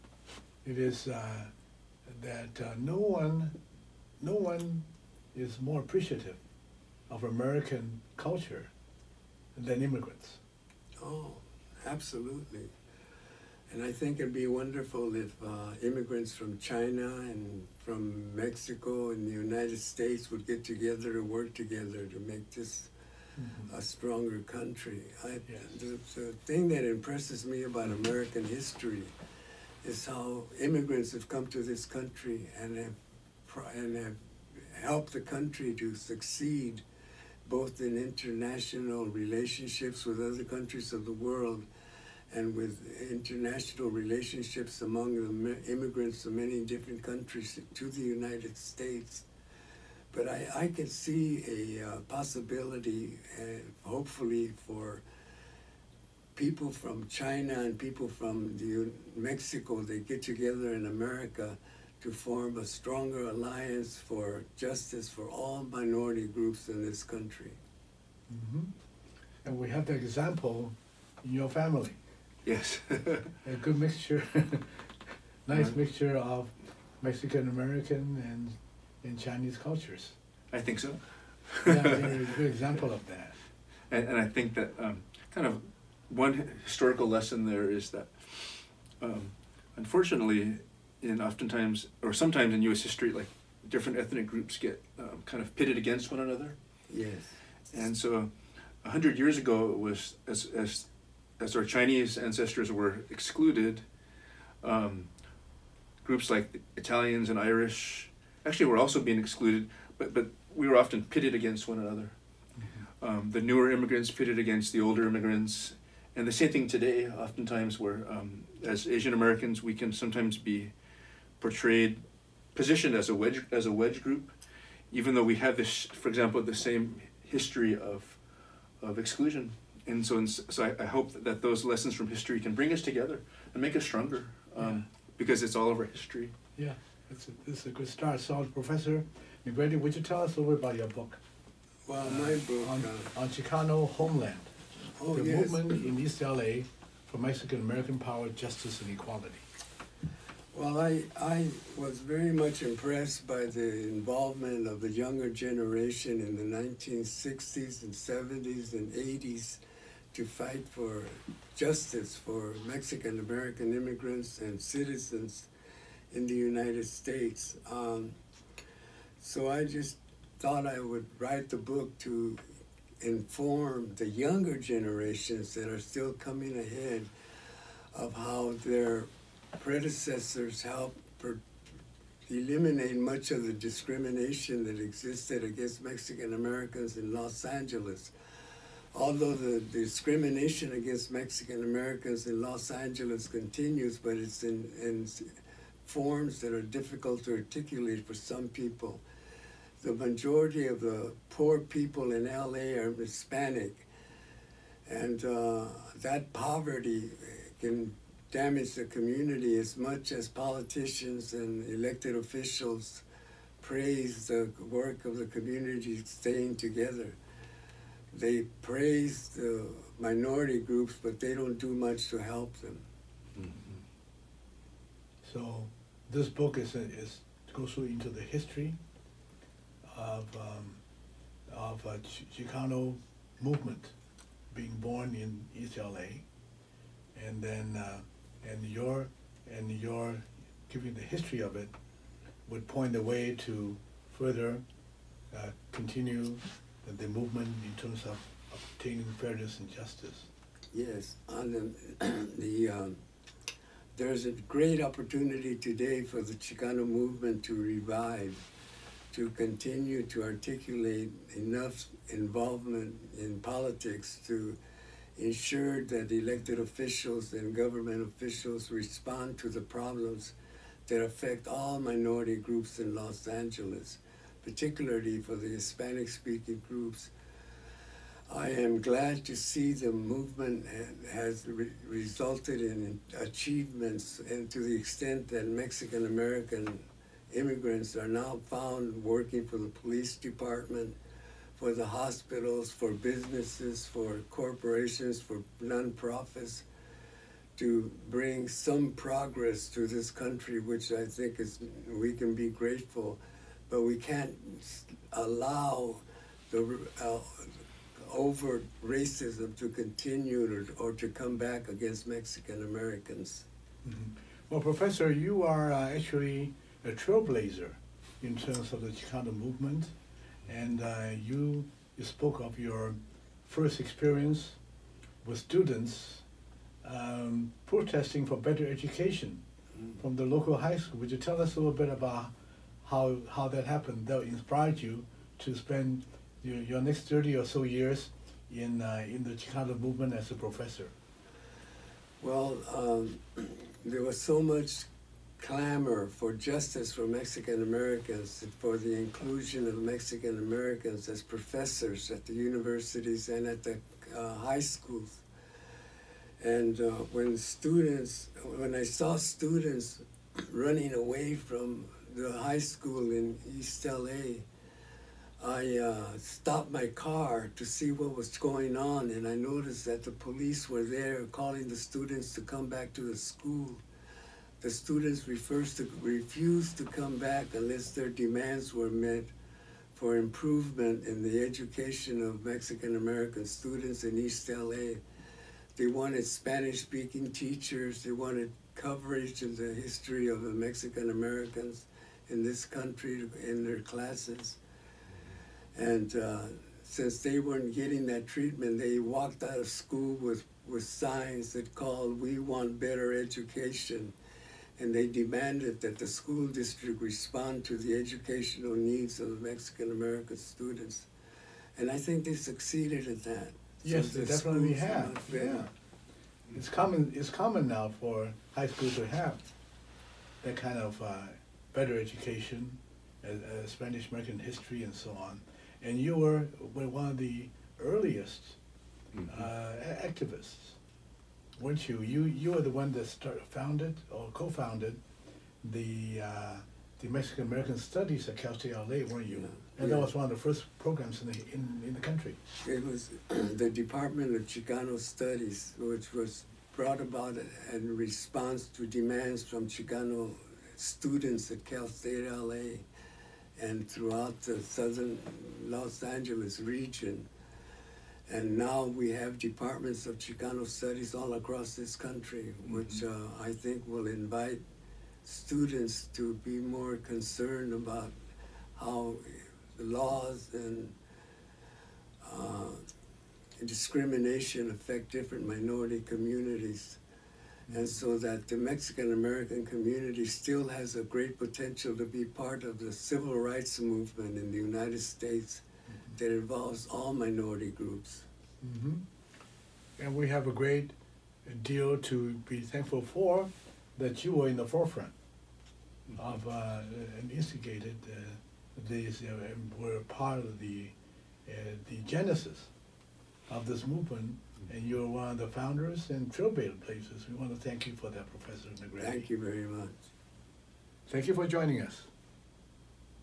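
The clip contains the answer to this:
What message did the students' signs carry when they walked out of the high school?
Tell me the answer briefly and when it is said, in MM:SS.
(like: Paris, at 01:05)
We want better education, at 06:42.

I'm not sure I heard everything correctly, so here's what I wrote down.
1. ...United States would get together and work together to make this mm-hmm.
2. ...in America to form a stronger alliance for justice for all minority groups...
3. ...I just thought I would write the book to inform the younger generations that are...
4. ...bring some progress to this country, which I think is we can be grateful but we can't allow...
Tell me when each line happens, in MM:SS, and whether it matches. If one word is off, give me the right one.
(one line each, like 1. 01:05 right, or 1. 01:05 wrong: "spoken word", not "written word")
1. 00:19 right
2. 01:00 right
3. 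02:49 right
4. 04:58 right.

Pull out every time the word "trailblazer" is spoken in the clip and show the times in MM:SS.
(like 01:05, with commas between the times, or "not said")
05:16, 08:26.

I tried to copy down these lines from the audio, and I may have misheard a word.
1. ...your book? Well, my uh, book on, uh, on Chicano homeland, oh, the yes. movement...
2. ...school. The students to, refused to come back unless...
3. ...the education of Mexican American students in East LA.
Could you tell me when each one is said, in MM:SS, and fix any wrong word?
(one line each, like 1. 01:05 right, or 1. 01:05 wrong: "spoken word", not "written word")
1. 02:20 right
2. 06:13 right
3. 06:21 right.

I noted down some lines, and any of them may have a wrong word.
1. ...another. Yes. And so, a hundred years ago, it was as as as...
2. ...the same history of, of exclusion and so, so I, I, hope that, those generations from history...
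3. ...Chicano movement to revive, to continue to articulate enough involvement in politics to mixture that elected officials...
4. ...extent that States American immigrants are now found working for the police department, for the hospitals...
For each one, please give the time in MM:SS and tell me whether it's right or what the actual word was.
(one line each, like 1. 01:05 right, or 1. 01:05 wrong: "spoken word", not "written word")
1. 01:36 right
2. 02:06 wrong: "lessons", not "generations"
3. 04:16 wrong: "ensure", not "mixture"
4. 04:44 wrong: "Mexican", not "States".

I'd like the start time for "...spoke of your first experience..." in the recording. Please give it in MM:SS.
05:22.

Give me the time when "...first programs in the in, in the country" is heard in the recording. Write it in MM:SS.
07:20.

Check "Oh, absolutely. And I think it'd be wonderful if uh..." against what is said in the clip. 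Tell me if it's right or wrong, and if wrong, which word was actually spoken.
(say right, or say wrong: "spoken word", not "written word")
right.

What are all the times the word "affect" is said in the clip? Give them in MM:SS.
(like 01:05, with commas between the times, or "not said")
04:31, 07:54.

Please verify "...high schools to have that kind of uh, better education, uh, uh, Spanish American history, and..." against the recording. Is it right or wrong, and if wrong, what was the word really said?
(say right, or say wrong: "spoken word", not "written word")
right.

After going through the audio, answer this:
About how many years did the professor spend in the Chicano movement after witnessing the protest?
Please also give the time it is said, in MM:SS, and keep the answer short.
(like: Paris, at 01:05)
30, at 05:37.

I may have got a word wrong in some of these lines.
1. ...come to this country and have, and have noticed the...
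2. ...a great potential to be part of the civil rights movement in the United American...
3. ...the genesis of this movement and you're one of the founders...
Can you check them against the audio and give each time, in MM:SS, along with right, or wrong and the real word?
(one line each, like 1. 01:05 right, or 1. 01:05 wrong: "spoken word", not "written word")
1. 00:31 wrong: "helped", not "noticed"
2. 08:00 wrong: "States", not "American"
3. 08:21 right.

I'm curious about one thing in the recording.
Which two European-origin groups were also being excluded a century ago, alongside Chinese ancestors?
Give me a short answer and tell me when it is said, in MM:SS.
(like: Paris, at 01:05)
Italians and Irish, at 01:46.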